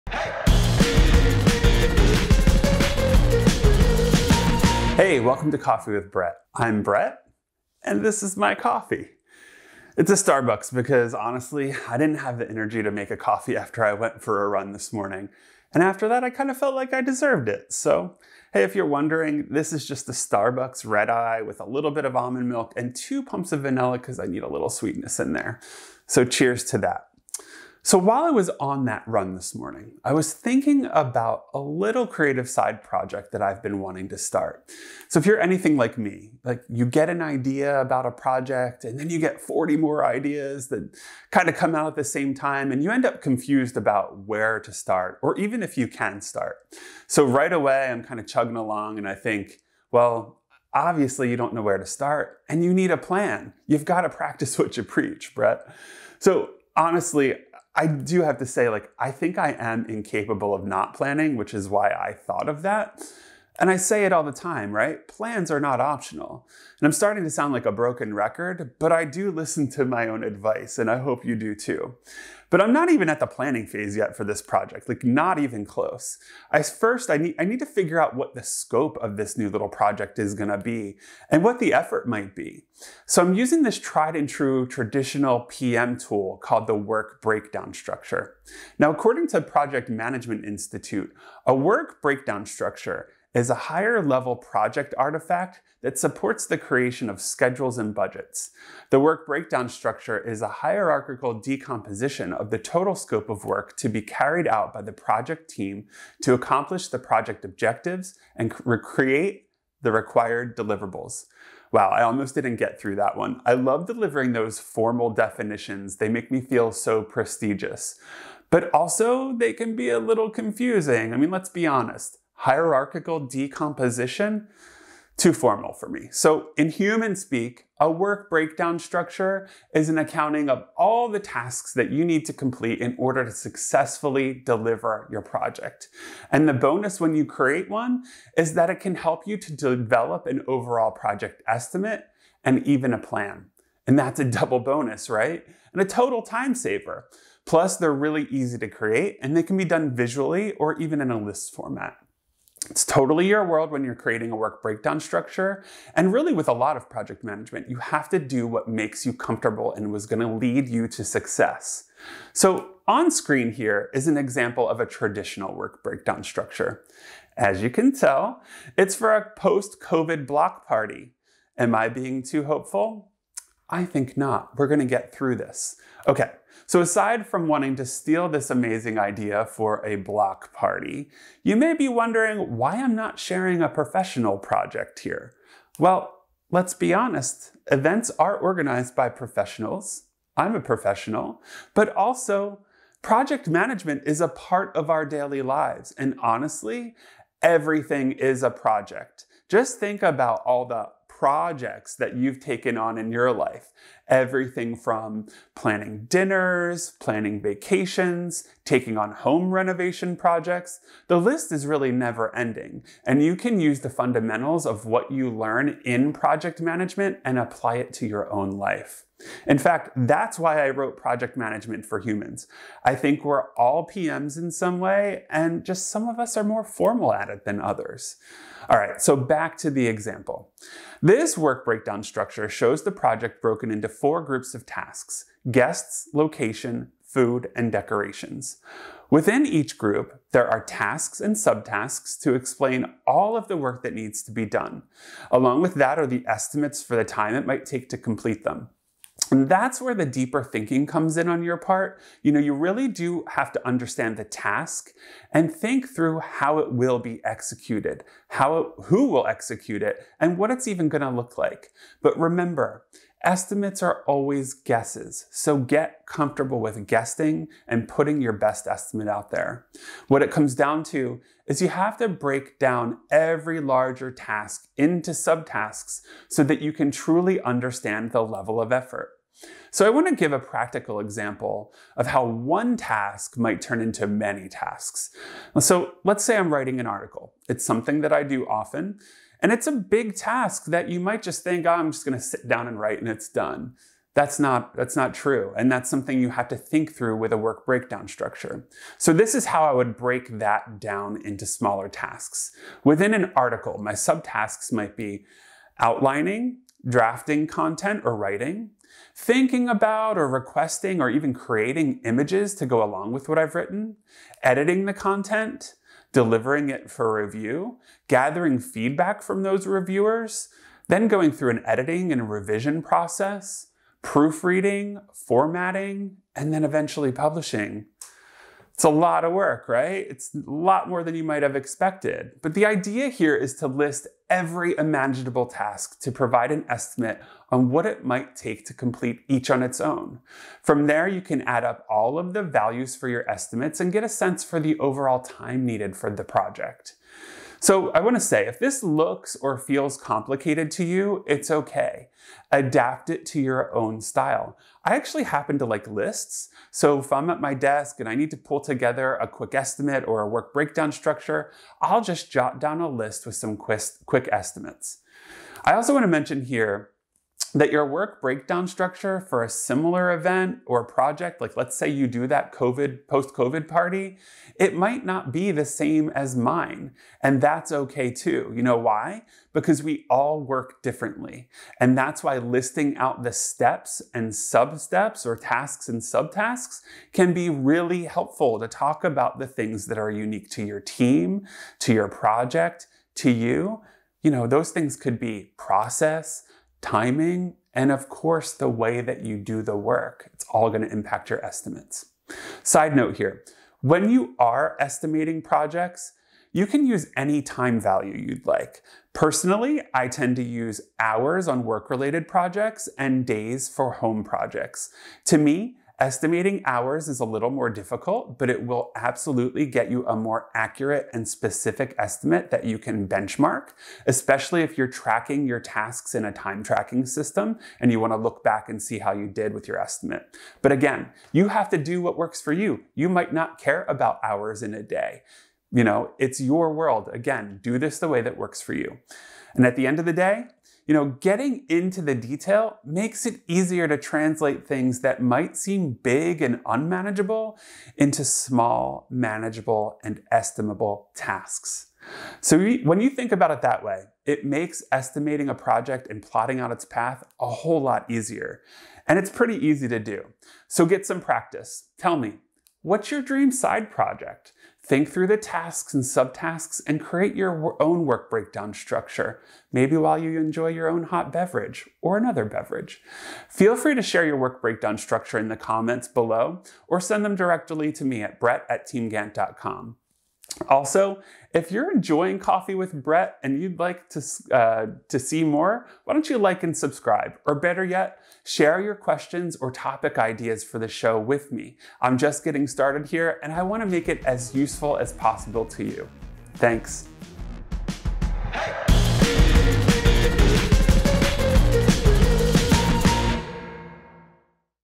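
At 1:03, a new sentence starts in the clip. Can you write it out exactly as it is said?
And I say it all the time, right?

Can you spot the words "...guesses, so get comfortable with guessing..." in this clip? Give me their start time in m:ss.
4:24.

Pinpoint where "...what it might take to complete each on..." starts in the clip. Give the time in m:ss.
5:37.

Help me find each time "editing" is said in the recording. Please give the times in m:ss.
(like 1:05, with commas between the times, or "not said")
5:14, 5:21.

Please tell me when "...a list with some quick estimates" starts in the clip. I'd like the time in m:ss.
6:02.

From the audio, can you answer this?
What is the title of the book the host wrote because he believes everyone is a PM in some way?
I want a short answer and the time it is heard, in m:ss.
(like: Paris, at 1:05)
Project Management for Humans, at 3:40.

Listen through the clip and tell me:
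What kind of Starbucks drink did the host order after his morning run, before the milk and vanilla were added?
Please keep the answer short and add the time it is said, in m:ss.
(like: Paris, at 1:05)
Red eye, at 0:20.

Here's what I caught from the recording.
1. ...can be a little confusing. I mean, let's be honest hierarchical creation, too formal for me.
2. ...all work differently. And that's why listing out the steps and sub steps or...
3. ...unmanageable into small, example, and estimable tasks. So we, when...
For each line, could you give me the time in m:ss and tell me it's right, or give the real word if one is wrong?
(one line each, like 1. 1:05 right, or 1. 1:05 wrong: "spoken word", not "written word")
1. 1:59 wrong: "decomposition", not "creation"
2. 6:20 right
3. 7:26 wrong: "manageable", not "example".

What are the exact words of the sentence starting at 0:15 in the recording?
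And after that, I kind of felt like I deserved it.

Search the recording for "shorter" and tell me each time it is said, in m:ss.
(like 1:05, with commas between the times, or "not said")
not said.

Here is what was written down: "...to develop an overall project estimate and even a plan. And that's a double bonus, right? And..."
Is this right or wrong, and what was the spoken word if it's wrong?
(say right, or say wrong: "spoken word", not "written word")
right.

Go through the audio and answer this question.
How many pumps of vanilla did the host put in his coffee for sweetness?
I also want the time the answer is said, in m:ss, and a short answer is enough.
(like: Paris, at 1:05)
2, at 0:22.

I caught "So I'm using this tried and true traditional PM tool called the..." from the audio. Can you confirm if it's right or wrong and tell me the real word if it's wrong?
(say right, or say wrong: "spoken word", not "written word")
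right.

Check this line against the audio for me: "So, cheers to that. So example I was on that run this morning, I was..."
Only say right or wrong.
wrong.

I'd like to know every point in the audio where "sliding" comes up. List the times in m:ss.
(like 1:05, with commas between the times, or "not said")
not said.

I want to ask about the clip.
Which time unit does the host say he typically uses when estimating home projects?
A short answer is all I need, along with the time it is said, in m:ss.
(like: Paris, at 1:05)
Days, at 6:53.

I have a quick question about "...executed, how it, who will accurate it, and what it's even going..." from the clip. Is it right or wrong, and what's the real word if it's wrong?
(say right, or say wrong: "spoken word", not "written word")
wrong: "execute", not "accurate".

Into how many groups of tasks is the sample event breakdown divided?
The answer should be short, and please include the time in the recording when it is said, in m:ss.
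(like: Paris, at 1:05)
4, at 3:54.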